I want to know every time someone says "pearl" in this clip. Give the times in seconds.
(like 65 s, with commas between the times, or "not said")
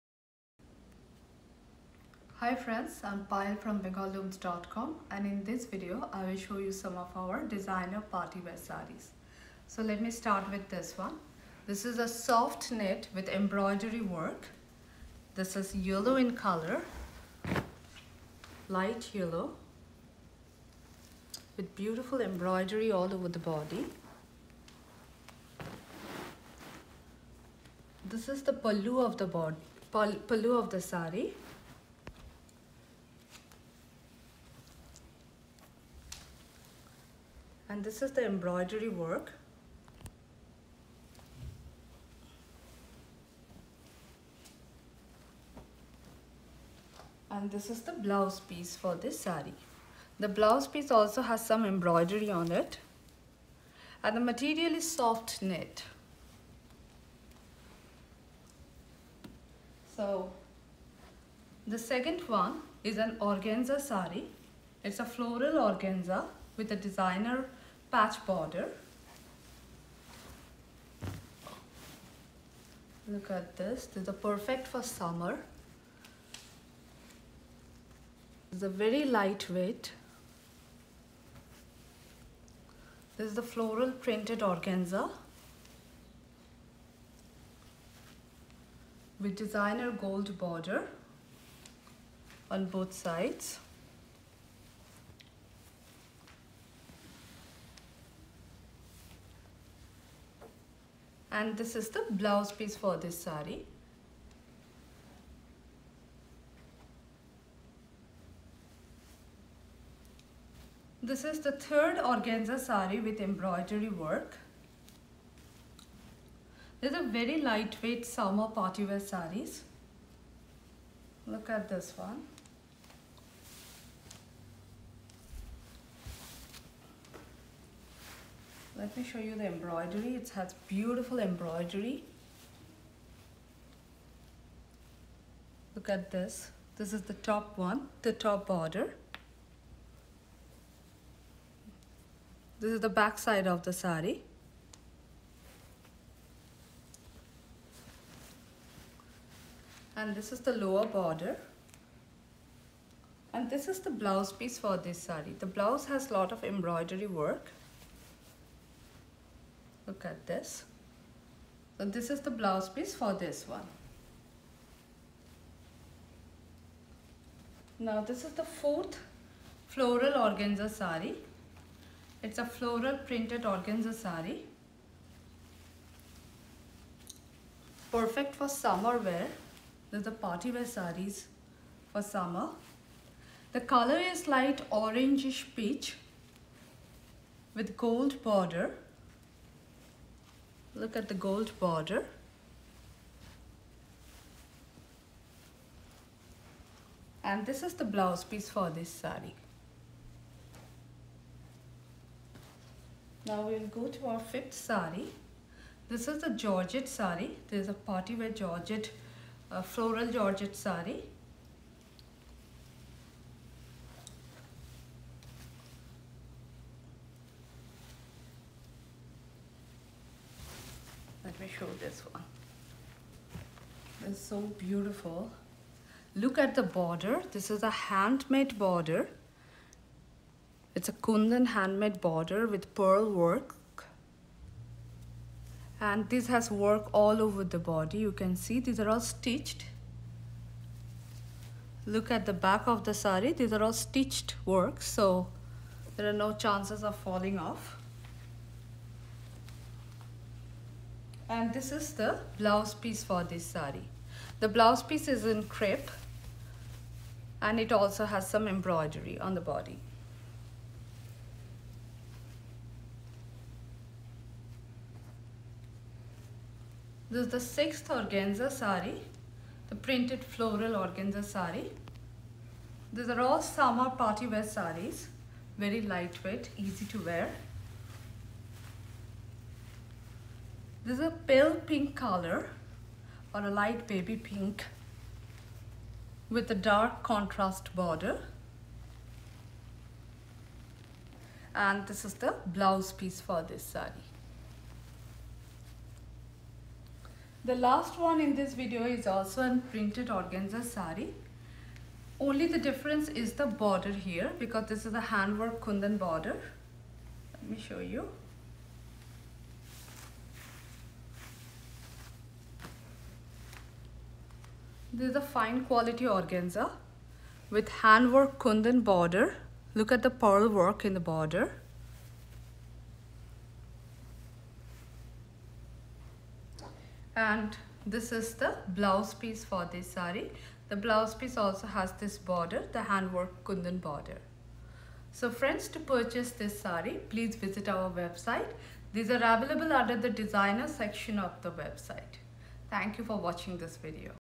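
232 s, 320 s.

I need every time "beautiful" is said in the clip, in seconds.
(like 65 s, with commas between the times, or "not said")
21 s, 130 s, 224 s.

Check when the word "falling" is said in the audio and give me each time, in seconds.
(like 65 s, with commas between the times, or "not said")
246 s.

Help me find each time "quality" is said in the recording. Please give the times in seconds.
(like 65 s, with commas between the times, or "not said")
315 s.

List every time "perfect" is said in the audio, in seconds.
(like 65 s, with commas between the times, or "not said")
74 s, 177 s.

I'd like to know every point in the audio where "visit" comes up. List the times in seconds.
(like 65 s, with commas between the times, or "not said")
337 s.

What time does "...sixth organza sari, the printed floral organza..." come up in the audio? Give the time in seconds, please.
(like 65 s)
267 s.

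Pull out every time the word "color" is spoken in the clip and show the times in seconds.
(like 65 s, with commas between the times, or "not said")
16 s, 183 s, 281 s.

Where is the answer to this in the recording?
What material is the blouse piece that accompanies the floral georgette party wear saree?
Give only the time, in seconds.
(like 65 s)
255 s.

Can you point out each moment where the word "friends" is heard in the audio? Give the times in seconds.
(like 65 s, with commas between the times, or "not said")
2 s, 335 s.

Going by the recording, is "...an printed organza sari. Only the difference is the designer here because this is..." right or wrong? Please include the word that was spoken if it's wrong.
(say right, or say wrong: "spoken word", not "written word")
wrong: "border", not "designer".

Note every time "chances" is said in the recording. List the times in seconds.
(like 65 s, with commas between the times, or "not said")
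246 s.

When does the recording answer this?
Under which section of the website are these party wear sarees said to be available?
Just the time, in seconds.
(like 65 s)
340 s.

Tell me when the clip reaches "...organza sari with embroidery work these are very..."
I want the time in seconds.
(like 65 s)
112 s.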